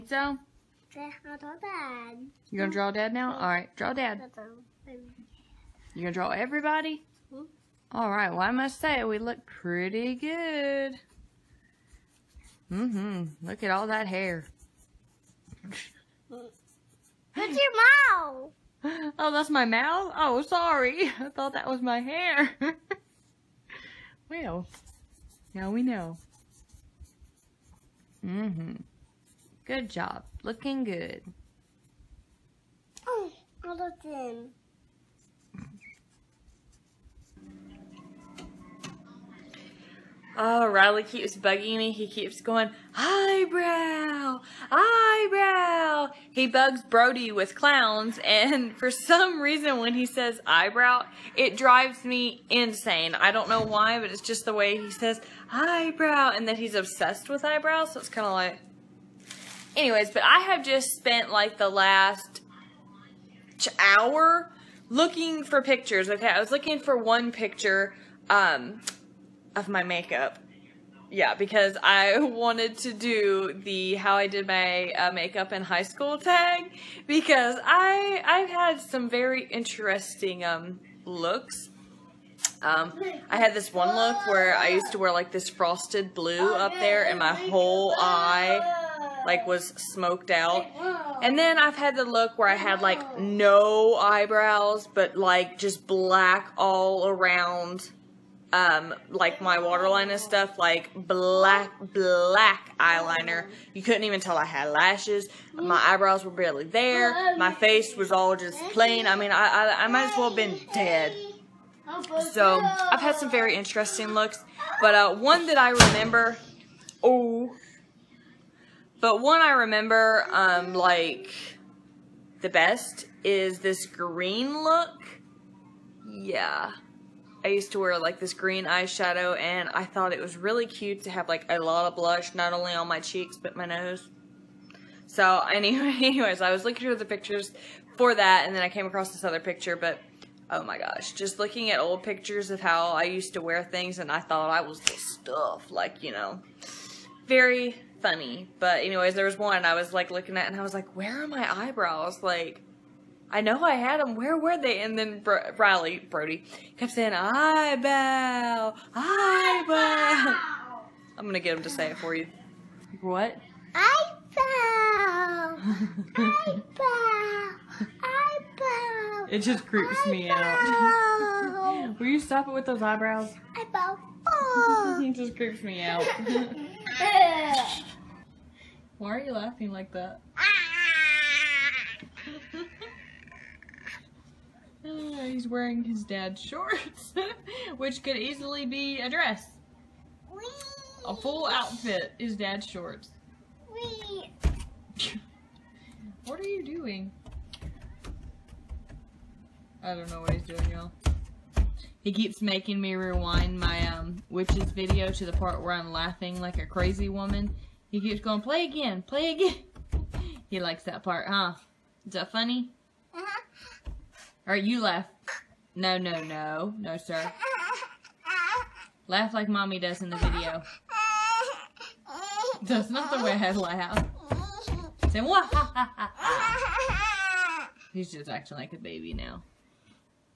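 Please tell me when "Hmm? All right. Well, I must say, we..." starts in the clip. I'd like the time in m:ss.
0:07.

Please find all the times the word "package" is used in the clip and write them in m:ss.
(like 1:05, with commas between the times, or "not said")
not said.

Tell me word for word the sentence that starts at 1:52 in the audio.
So, I've had some very interesting looks.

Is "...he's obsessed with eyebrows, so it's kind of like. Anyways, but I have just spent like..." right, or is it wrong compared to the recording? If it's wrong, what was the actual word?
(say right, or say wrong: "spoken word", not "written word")
right.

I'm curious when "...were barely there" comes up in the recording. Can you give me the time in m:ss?
1:46.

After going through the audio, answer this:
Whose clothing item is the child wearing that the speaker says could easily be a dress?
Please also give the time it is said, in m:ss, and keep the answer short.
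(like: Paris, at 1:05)
His dad's shorts, at 3:05.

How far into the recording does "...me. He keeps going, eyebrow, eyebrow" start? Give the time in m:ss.
0:41.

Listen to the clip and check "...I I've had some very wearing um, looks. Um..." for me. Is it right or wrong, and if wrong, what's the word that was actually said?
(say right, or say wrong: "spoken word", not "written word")
wrong: "interesting", not "wearing".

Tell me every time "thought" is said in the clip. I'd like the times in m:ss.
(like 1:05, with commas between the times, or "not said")
0:21, 2:09, 2:24.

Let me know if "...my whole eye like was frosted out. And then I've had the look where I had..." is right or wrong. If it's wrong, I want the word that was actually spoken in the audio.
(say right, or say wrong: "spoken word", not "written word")
wrong: "smoked", not "frosted".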